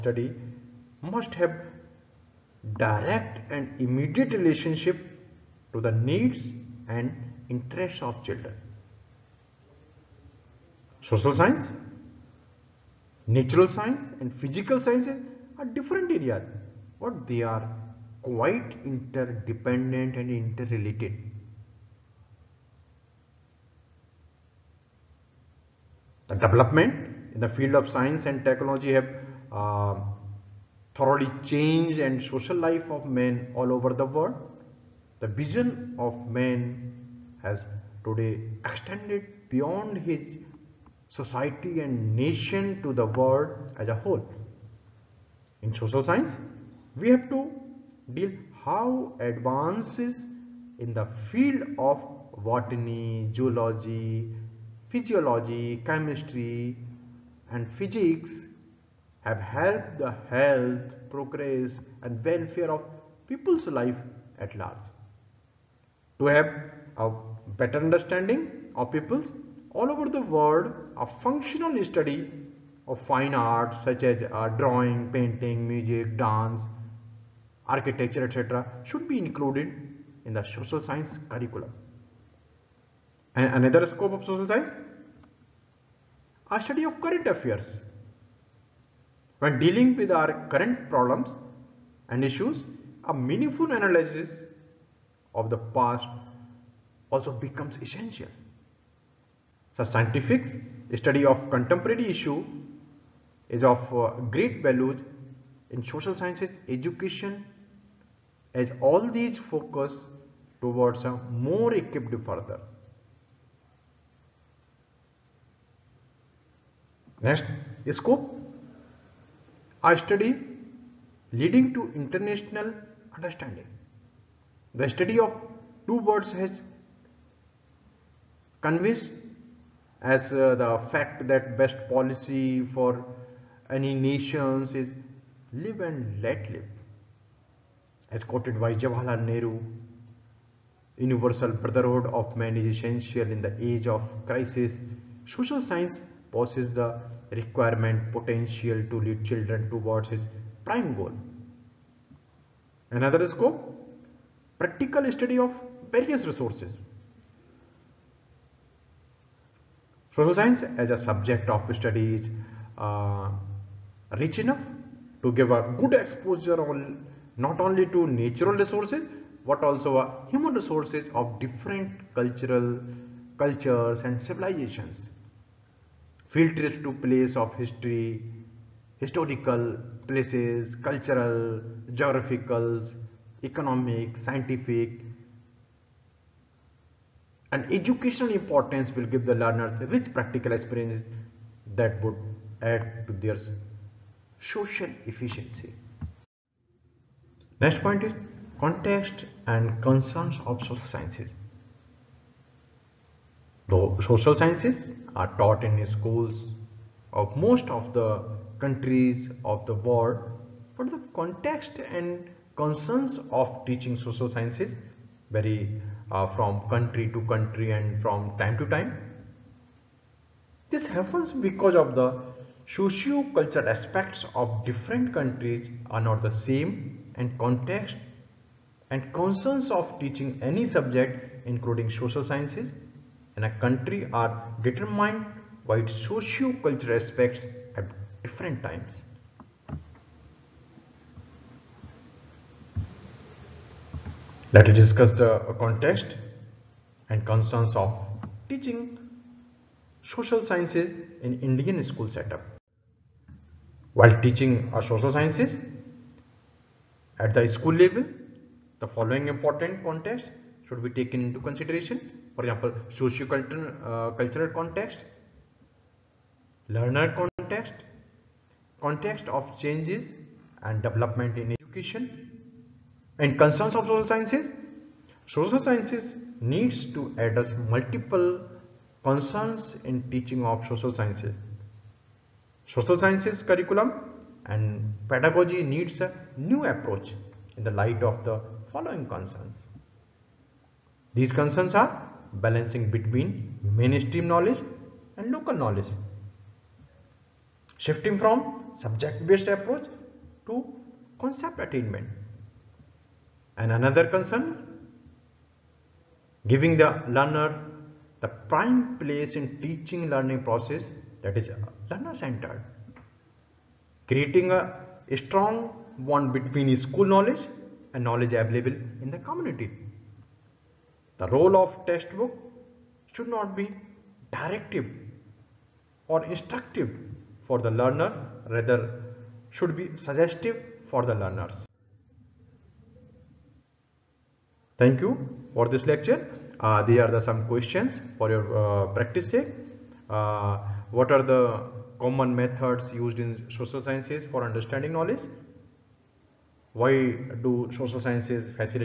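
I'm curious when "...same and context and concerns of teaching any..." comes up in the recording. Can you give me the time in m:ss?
3:46.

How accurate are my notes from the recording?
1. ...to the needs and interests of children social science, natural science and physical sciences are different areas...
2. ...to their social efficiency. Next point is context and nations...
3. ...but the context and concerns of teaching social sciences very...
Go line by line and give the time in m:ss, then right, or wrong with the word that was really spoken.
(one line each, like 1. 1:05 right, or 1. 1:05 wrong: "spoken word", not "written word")
1. 0:05 right
2. 3:13 wrong: "concerns", not "nations"
3. 3:30 right.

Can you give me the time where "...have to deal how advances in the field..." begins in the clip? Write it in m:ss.
0:47.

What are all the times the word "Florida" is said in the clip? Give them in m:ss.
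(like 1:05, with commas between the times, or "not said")
not said.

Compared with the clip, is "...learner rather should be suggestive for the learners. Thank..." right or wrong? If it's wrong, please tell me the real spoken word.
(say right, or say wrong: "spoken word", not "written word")
right.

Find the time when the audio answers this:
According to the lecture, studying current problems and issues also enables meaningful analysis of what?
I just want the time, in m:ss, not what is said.
1:35.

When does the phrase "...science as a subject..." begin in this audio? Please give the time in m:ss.
2:40.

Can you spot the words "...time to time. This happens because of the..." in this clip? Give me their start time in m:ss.
3:38.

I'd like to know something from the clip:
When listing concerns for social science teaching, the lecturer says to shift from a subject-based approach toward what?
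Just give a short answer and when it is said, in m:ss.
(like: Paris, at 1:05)
Concept attainment, at 5:01.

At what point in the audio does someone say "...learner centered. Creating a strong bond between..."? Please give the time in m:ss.
5:11.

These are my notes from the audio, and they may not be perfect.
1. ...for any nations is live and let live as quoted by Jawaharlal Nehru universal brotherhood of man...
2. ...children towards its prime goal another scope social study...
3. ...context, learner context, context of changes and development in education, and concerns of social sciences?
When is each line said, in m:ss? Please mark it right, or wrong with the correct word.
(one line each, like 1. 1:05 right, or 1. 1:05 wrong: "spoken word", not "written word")
1. 2:12 right
2. 2:29 wrong: "practical", not "social"
3. 4:24 right.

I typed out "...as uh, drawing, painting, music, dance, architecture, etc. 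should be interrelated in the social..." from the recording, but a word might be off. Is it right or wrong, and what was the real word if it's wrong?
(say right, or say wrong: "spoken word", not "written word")
wrong: "included", not "interrelated".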